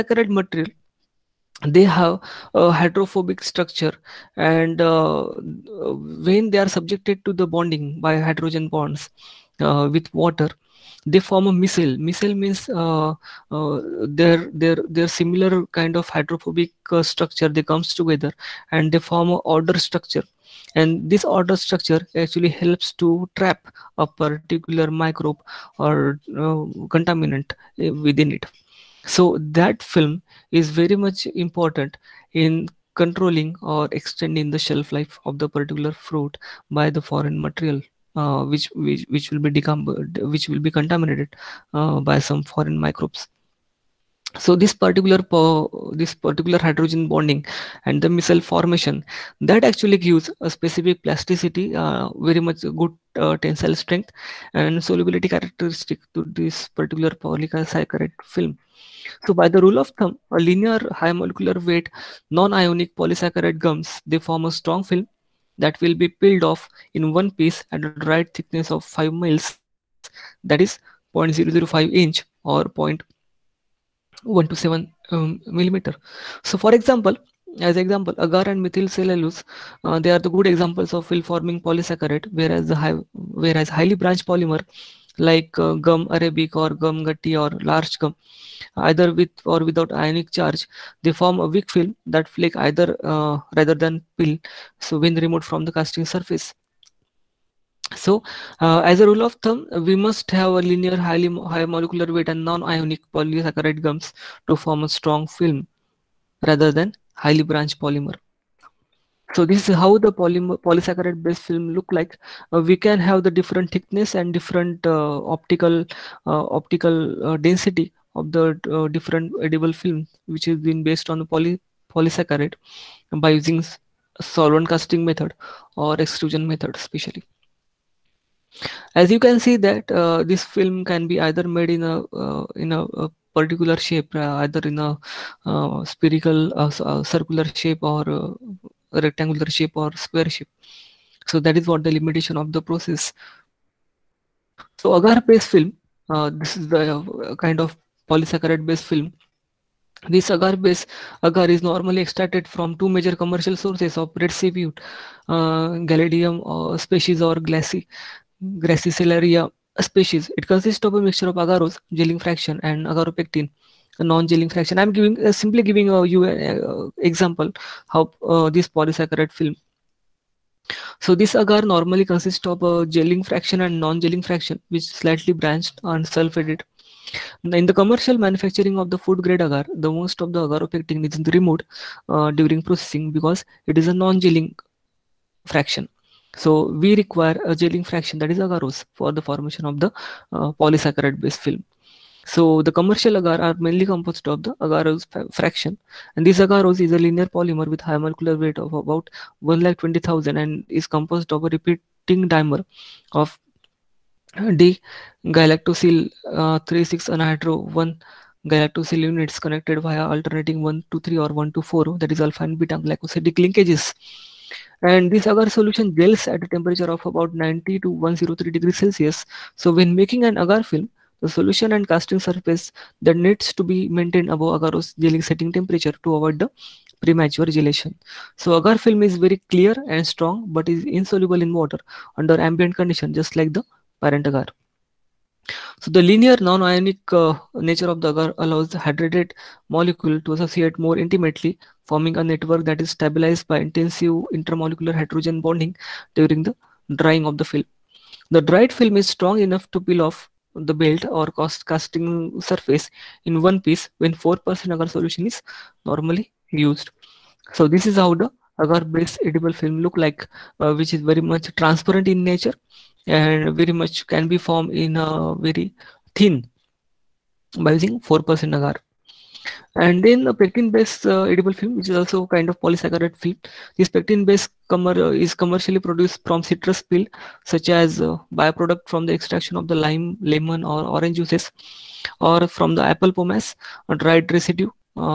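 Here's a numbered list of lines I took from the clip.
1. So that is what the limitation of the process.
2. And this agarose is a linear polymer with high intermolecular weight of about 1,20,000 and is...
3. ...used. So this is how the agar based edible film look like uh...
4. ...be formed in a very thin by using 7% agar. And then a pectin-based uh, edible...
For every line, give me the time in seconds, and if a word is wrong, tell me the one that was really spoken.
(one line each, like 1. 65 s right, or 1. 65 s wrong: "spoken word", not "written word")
1. 141 s right
2. 196 s wrong: "molecular", not "intermolecular"
3. 256 s right
4. 264 s wrong: "4", not "7".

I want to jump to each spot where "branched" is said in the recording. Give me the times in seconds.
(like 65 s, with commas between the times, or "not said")
83 s, 107 s, 175 s.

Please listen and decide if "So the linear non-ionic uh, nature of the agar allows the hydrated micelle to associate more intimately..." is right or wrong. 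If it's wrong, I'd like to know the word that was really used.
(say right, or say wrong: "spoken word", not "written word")
wrong: "molecule", not "micelle".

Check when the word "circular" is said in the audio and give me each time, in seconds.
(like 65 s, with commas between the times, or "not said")
137 s.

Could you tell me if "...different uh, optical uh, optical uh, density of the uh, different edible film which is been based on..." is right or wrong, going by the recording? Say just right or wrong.
right.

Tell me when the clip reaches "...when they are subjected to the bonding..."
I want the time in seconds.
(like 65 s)
6 s.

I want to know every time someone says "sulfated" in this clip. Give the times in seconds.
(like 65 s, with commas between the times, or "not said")
176 s.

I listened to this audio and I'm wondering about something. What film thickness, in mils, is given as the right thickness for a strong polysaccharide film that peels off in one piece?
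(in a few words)
5 mils.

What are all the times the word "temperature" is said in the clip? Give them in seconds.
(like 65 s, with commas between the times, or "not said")
216 s, 225 s.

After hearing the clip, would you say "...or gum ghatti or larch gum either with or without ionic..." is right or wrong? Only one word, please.
right.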